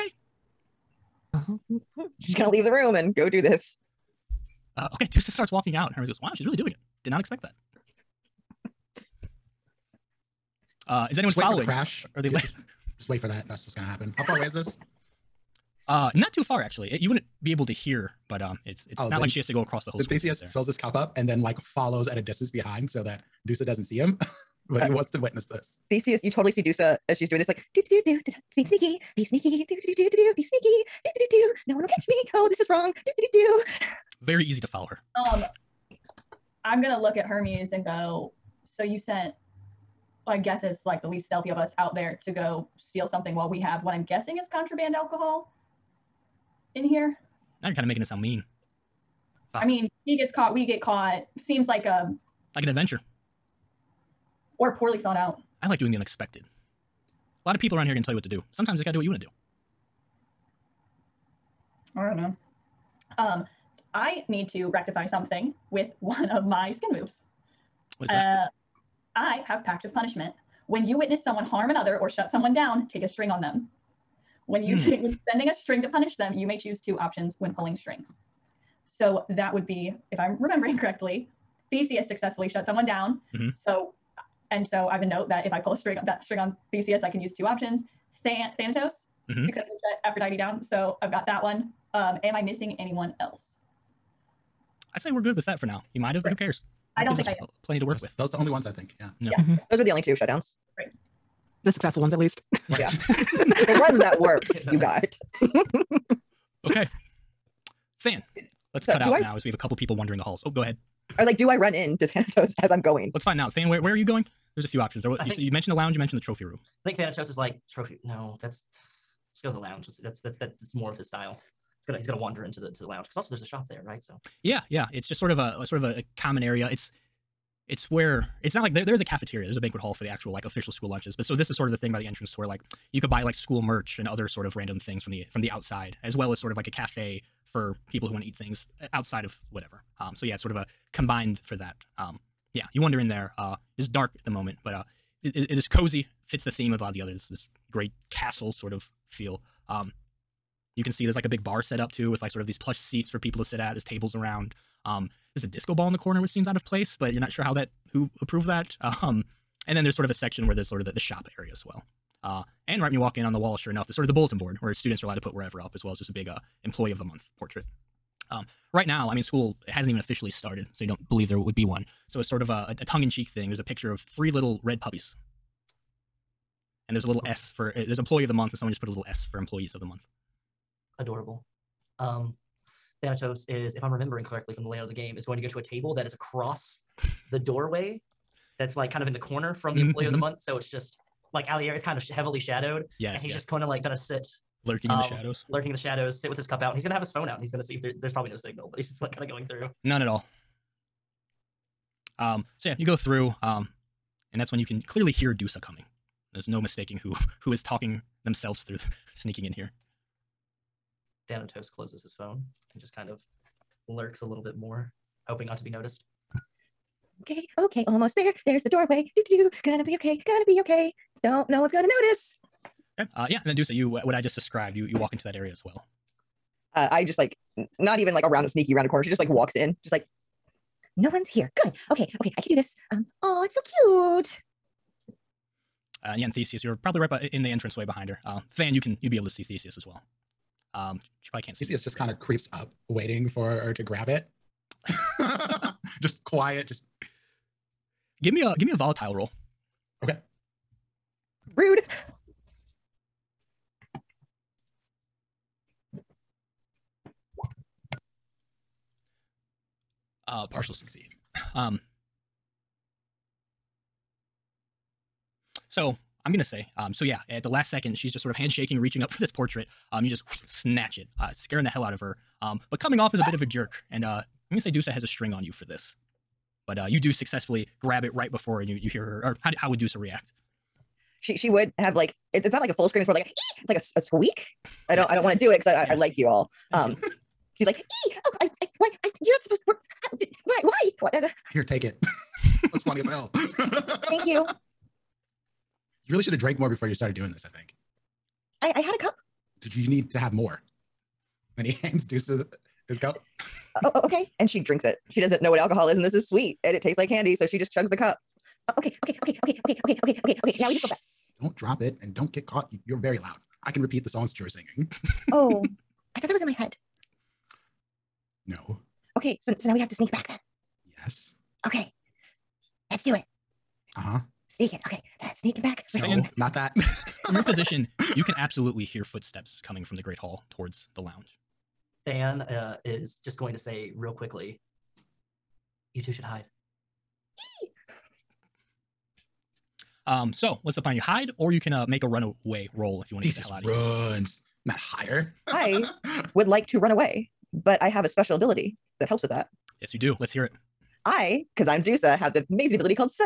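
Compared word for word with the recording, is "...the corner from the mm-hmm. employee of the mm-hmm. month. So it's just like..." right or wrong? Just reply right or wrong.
right.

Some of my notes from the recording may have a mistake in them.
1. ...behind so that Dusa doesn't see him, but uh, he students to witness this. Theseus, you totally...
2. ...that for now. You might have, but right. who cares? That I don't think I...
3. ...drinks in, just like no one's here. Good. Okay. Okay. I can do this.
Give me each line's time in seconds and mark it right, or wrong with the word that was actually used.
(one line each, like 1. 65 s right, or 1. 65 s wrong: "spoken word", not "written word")
1. 22 s wrong: "wants", not "students"
2. 95 s right
3. 229 s wrong: "walks", not "drinks".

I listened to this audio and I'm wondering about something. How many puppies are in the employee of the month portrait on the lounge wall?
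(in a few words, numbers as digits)
3.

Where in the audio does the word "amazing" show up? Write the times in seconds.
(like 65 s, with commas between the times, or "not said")
352 s.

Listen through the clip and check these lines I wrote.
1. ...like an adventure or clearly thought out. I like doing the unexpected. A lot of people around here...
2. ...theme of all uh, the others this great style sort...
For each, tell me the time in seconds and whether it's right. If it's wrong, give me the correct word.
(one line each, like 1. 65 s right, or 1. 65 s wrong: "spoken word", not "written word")
1. 52 s wrong: "poorly", not "clearly"
2. 146 s wrong: "castle", not "style".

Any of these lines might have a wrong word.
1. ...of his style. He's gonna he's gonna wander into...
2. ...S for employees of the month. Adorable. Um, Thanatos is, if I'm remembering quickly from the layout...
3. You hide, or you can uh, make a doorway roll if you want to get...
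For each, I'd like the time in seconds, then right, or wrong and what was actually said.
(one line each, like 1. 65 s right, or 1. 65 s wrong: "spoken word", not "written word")
1. 120 s right
2. 179 s wrong: "correctly", not "quickly"
3. 340 s wrong: "runaway", not "doorway".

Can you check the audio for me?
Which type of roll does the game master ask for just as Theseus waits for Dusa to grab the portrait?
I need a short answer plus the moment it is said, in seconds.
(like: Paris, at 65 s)
volatile roll, at 248 s.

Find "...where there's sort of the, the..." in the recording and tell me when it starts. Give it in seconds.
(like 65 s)
160 s.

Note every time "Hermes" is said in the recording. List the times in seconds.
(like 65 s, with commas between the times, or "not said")
5 s, 37 s.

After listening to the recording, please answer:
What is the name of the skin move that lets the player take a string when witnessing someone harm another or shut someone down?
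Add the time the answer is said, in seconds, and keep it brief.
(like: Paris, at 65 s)
Pact of Punishment, at 69 s.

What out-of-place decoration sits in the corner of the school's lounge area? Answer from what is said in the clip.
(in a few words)
a disco ball.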